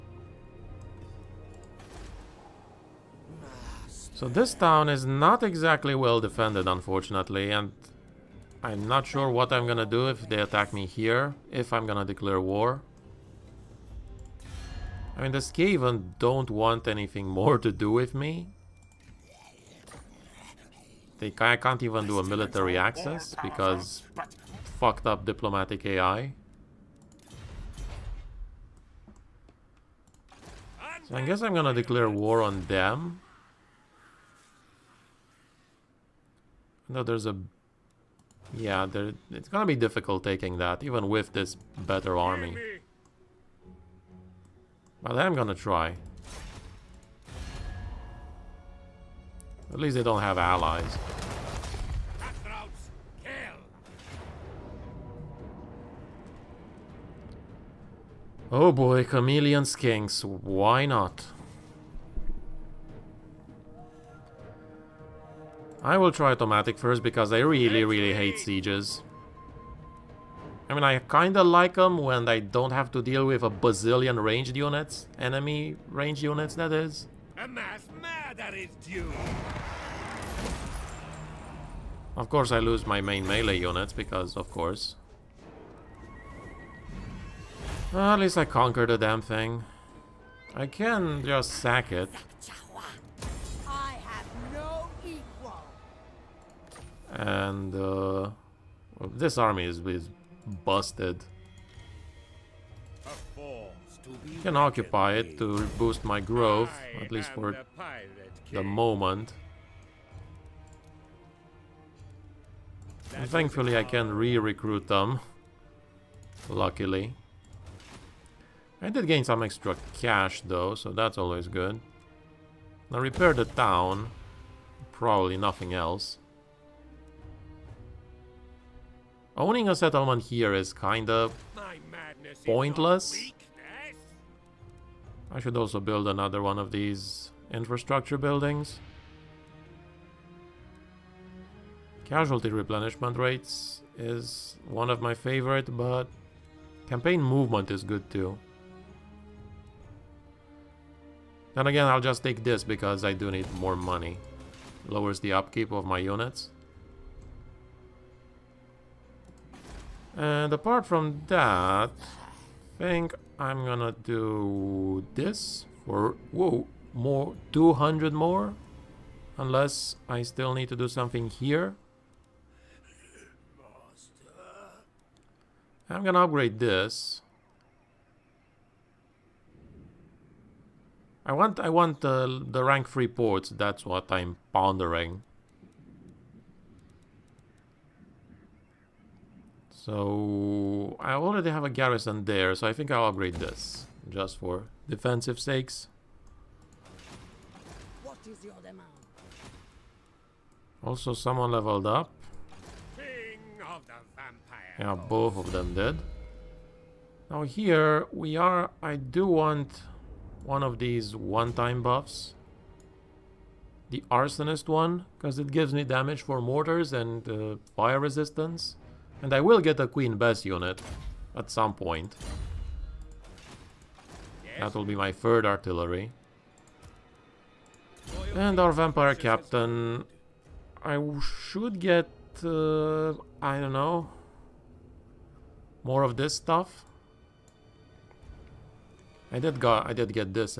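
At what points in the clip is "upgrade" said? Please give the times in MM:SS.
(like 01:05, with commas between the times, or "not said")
02:56, 03:13.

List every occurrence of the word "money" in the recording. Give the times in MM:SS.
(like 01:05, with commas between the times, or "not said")
02:33.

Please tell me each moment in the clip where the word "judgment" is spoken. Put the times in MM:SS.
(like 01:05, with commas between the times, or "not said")
not said.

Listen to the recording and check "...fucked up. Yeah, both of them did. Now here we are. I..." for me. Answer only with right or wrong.
wrong.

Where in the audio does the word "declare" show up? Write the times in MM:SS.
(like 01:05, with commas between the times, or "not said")
00:12, 00:31.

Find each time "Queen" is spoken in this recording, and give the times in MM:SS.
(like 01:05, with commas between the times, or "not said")
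03:39.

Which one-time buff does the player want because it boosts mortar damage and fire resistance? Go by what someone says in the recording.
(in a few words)
Arsonist.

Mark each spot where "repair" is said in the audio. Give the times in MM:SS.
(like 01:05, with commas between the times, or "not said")
02:03.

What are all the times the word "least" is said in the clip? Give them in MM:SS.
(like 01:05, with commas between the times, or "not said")
00:49, 01:28, 01:47.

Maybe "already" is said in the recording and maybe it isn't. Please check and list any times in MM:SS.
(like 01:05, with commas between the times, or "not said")
03:11.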